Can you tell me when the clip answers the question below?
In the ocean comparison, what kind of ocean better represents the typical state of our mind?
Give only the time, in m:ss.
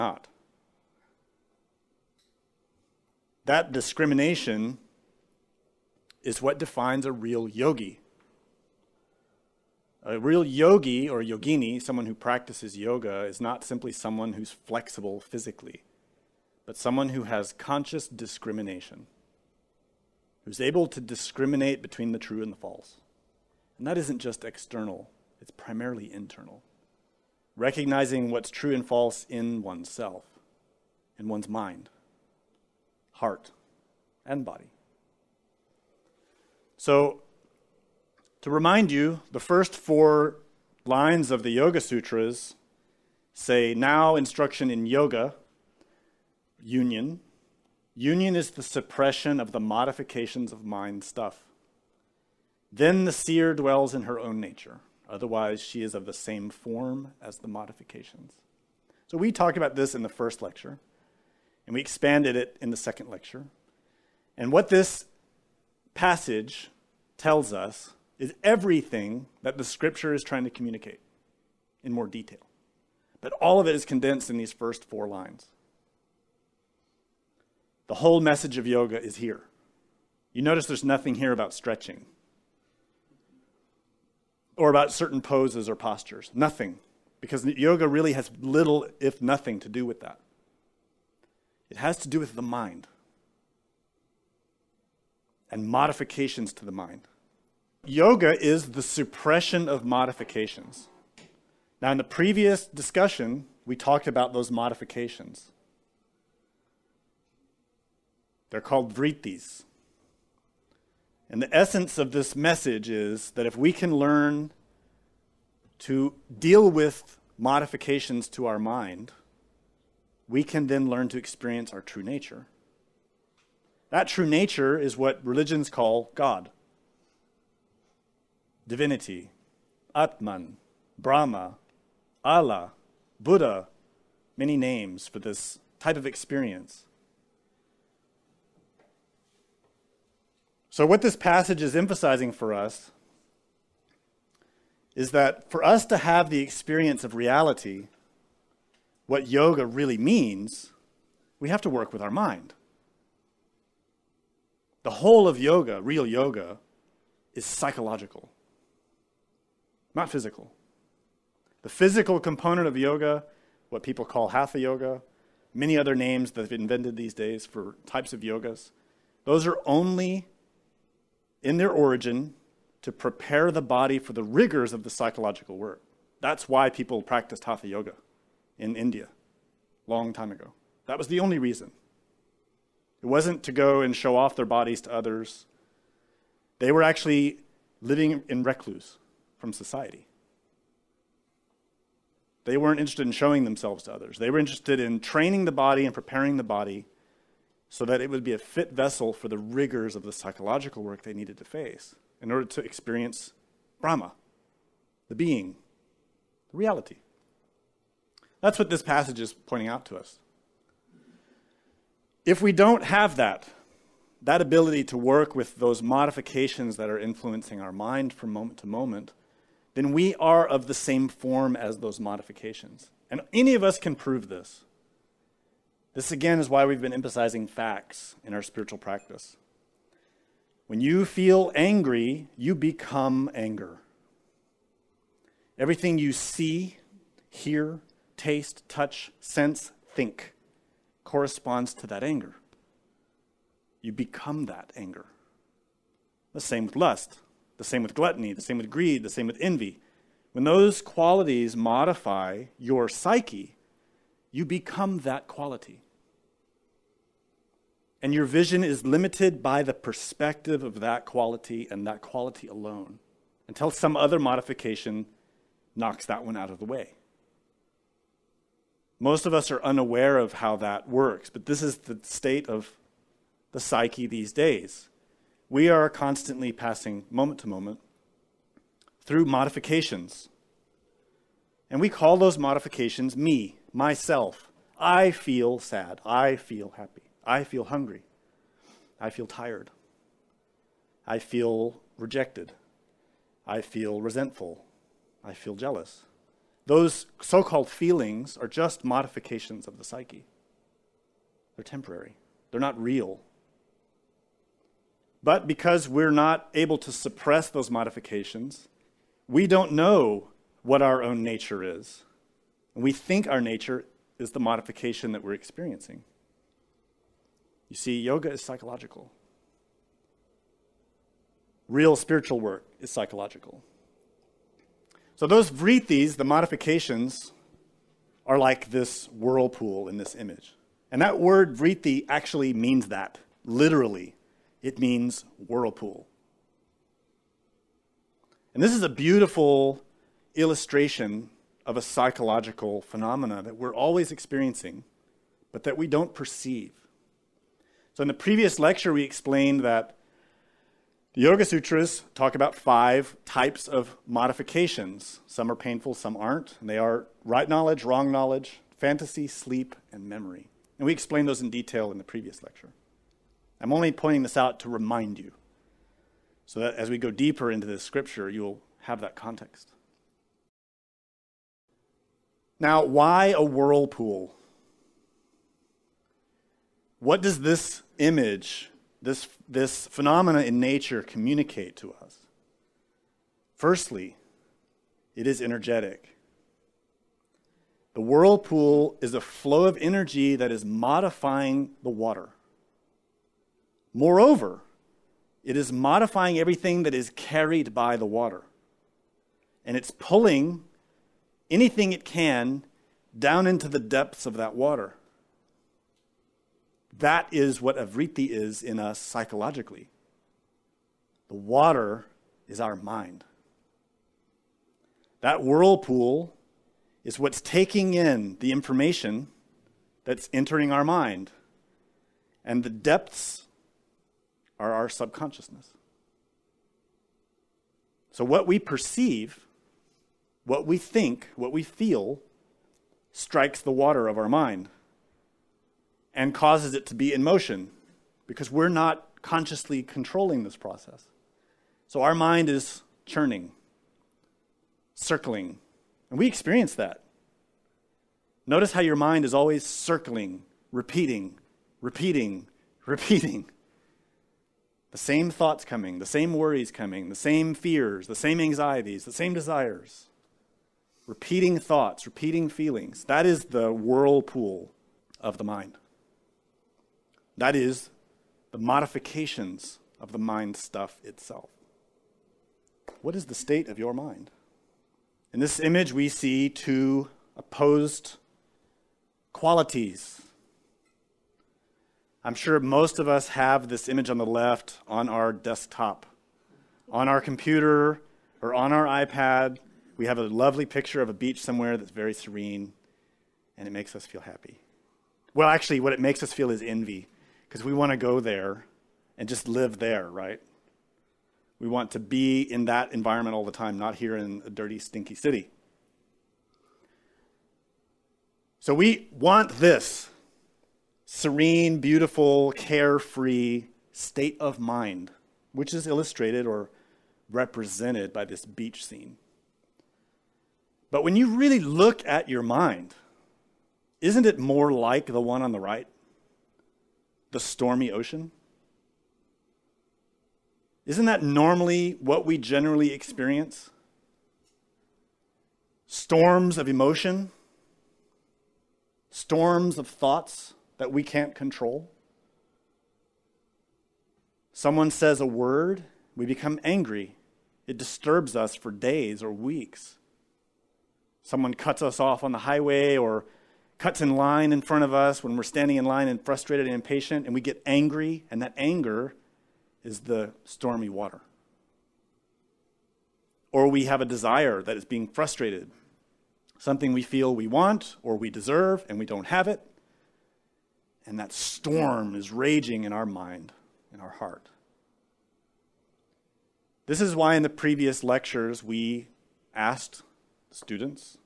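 8:47.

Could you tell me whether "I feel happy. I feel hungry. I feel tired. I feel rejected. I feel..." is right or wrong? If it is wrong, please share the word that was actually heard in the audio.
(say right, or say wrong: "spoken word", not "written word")
right.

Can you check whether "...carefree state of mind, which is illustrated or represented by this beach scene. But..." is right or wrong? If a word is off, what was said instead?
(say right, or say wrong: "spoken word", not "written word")
right.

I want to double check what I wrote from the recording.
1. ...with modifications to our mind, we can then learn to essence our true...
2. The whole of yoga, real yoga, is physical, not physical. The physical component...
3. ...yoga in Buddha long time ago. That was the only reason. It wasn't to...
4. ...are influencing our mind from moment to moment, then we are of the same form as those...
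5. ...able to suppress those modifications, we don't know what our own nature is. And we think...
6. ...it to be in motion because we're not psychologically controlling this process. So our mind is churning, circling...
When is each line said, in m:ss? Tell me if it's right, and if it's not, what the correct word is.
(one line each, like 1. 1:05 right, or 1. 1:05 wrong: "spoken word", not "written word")
1. 1:56 wrong: "experience", not "essence"
2. 2:34 wrong: "psychological", not "physical"
3. 2:57 wrong: "India", not "Buddha"
4. 3:36 right
5. 5:06 right
6. 7:16 wrong: "consciously", not "psychologically".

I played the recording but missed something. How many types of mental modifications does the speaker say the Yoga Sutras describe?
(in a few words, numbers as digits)
5.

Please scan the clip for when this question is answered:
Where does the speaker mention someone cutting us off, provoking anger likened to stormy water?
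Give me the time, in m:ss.
9:12.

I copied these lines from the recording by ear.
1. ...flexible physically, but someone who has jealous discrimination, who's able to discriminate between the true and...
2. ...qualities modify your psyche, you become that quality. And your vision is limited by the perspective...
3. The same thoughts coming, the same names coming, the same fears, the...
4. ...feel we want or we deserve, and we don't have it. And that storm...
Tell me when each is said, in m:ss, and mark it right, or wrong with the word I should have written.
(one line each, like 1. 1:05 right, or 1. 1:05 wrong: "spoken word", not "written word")
1. 0:14 wrong: "conscious", not "jealous"
2. 4:10 right
3. 7:34 wrong: "worries", not "names"
4. 9:27 right.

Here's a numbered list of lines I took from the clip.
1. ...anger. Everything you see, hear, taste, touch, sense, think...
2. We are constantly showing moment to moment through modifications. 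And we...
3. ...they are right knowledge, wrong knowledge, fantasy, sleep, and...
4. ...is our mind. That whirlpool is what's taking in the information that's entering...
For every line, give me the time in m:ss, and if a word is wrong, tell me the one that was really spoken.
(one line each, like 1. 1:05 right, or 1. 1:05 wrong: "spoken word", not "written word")
1. 3:53 right
2. 4:35 wrong: "passing", not "showing"
3. 5:56 right
4. 6:52 right.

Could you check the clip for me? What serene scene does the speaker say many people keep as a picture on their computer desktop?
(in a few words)
a beach.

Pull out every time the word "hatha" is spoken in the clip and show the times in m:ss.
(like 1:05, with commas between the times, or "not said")
2:44, 2:57.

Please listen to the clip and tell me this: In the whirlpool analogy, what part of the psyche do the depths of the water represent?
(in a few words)
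subconsciousness.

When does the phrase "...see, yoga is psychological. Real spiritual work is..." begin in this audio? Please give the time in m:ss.
5:17.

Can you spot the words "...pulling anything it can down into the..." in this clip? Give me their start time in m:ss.
6:39.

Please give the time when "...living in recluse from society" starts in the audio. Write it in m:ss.
3:07.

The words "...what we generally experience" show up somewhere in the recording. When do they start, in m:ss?
8:52.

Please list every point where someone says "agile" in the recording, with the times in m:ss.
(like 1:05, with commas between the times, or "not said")
not said.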